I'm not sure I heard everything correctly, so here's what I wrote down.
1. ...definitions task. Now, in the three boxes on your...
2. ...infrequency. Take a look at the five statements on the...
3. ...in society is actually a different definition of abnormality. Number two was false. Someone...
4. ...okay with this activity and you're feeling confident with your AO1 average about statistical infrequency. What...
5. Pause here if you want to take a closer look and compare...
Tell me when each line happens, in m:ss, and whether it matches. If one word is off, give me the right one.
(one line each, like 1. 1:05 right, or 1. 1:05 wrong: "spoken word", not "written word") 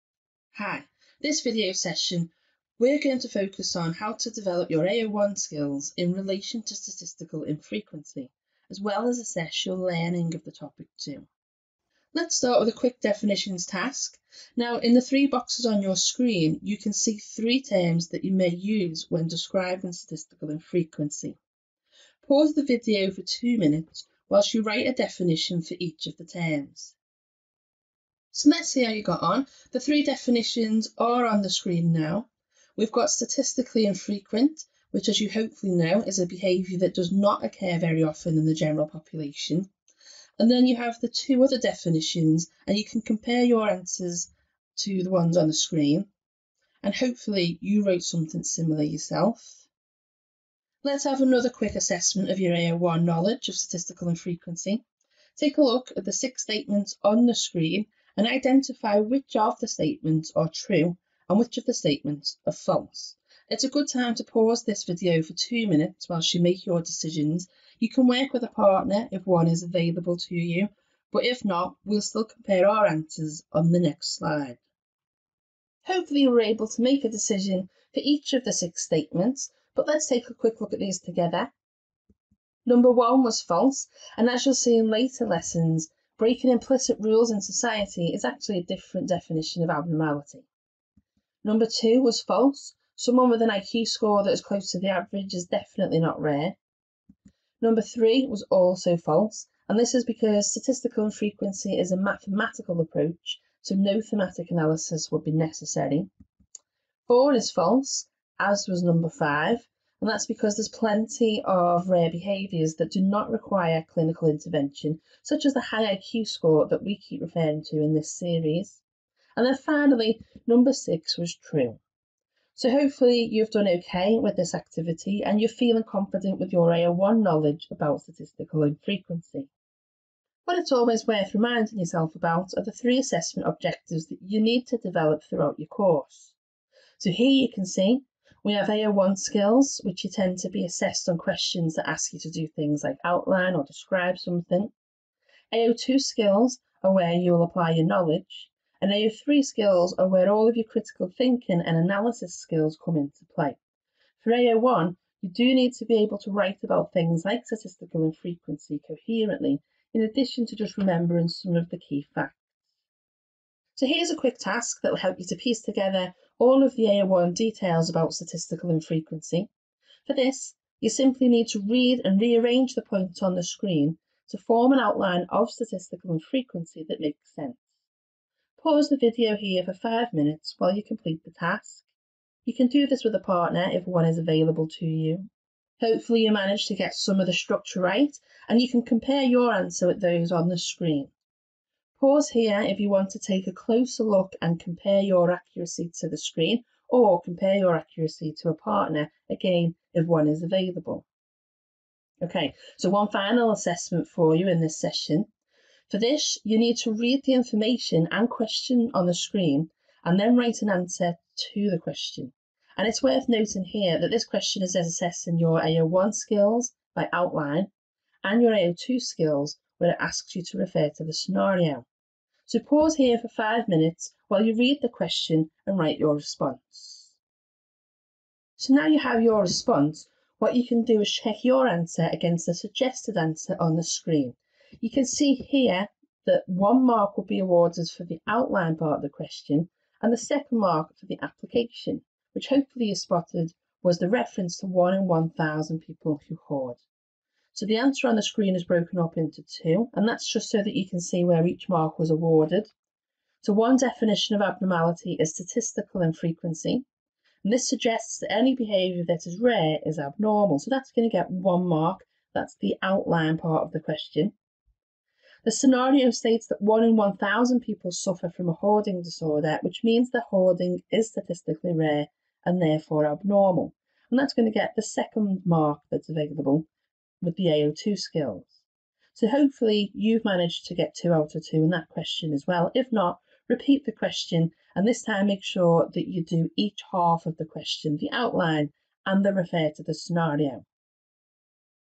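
1. 0:12 right
2. 0:54 wrong: "six", not "five"
3. 1:27 right
4. 2:03 wrong: "knowledge", not "average"
5. 3:12 right.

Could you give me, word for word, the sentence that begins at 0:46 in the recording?
And hopefully, you wrote something similar yourself.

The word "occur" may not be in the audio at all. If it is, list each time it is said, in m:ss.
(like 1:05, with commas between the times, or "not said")
0:37.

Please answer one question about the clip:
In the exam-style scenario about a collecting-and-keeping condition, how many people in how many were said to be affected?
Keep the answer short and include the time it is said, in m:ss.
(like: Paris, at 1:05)
1 in 1,000, at 4:04.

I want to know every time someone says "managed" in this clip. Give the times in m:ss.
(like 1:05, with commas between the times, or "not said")
3:06, 4:40.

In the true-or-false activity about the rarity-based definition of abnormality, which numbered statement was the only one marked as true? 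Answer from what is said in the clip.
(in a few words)
6.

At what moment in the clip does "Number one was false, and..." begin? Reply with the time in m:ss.
1:22.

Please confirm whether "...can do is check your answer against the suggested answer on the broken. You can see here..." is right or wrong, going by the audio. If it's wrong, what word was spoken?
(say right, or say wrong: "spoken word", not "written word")
wrong: "screen", not "broken".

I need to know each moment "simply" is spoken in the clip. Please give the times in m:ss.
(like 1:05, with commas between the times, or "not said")
2:50.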